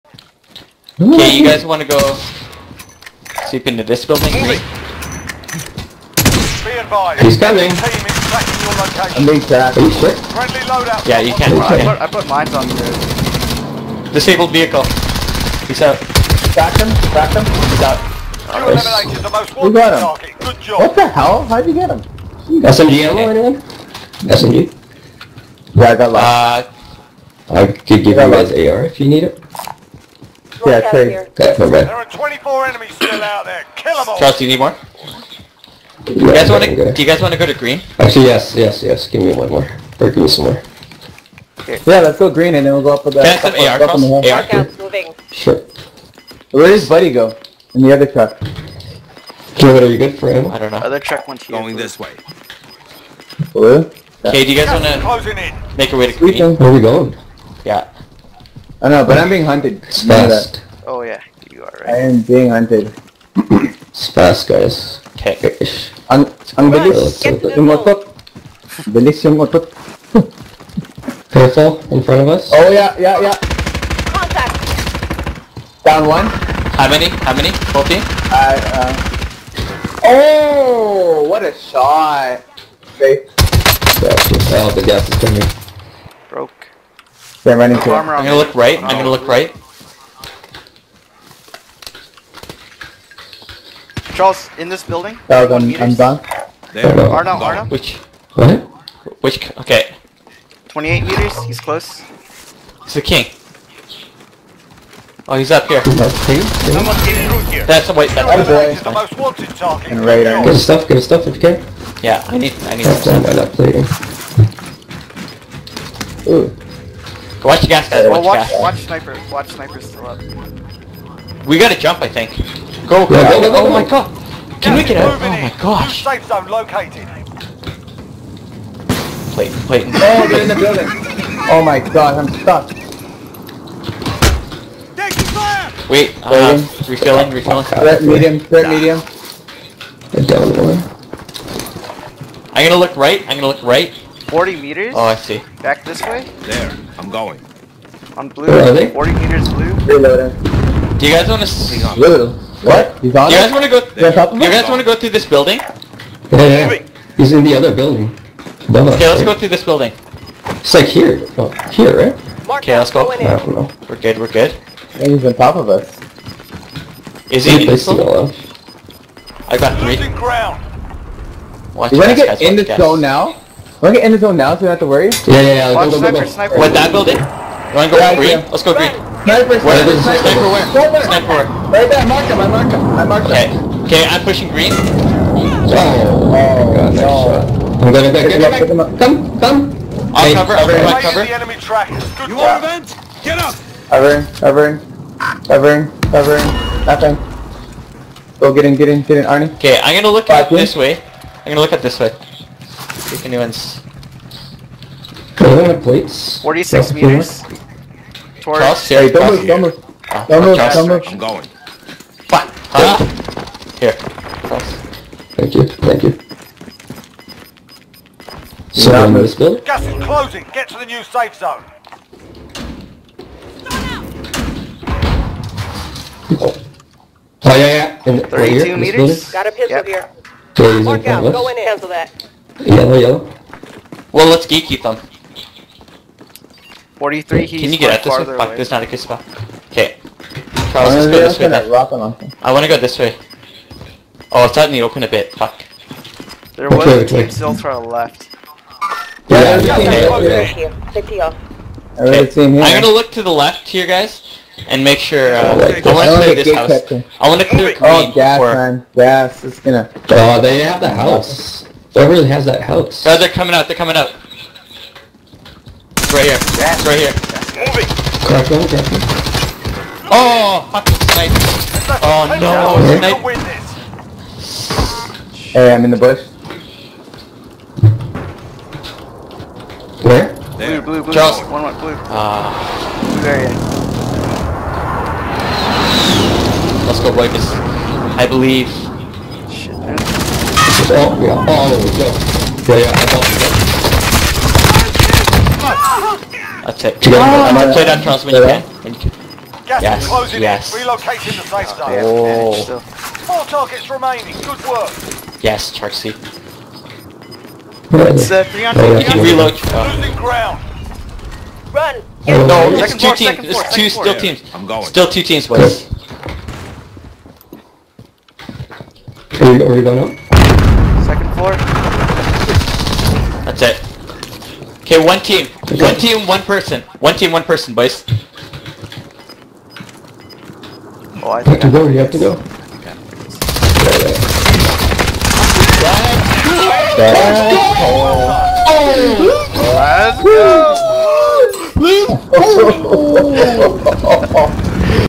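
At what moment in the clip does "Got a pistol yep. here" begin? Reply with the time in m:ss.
3:49.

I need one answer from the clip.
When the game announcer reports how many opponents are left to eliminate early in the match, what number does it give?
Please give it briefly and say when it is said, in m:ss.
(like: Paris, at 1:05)
24, at 0:32.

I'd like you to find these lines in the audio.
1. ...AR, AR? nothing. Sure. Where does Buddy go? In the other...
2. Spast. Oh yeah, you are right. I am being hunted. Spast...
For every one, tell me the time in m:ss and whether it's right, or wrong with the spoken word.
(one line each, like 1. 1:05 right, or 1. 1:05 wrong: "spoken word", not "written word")
1. 0:44 wrong: "moving", not "nothing"
2. 0:59 right.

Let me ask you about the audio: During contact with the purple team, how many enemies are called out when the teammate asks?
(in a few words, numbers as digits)
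14.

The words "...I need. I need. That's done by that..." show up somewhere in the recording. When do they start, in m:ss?
1:52.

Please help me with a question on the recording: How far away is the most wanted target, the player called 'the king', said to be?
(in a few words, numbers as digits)
28 meters.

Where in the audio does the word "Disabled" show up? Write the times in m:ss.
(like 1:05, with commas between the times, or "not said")
0:14.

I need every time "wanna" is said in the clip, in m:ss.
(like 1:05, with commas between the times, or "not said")
0:36, 2:57, 4:02.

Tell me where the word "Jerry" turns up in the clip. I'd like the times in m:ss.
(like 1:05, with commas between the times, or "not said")
3:28.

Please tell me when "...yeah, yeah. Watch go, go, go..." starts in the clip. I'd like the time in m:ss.
2:55.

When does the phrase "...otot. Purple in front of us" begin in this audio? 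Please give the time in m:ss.
1:09.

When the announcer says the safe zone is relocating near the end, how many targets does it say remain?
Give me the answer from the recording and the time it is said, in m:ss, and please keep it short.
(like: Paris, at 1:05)
4, at 5:02.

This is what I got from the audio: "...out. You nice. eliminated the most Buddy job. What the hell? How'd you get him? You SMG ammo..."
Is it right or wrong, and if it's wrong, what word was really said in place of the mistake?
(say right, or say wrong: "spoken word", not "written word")
wrong: "Good", not "Buddy".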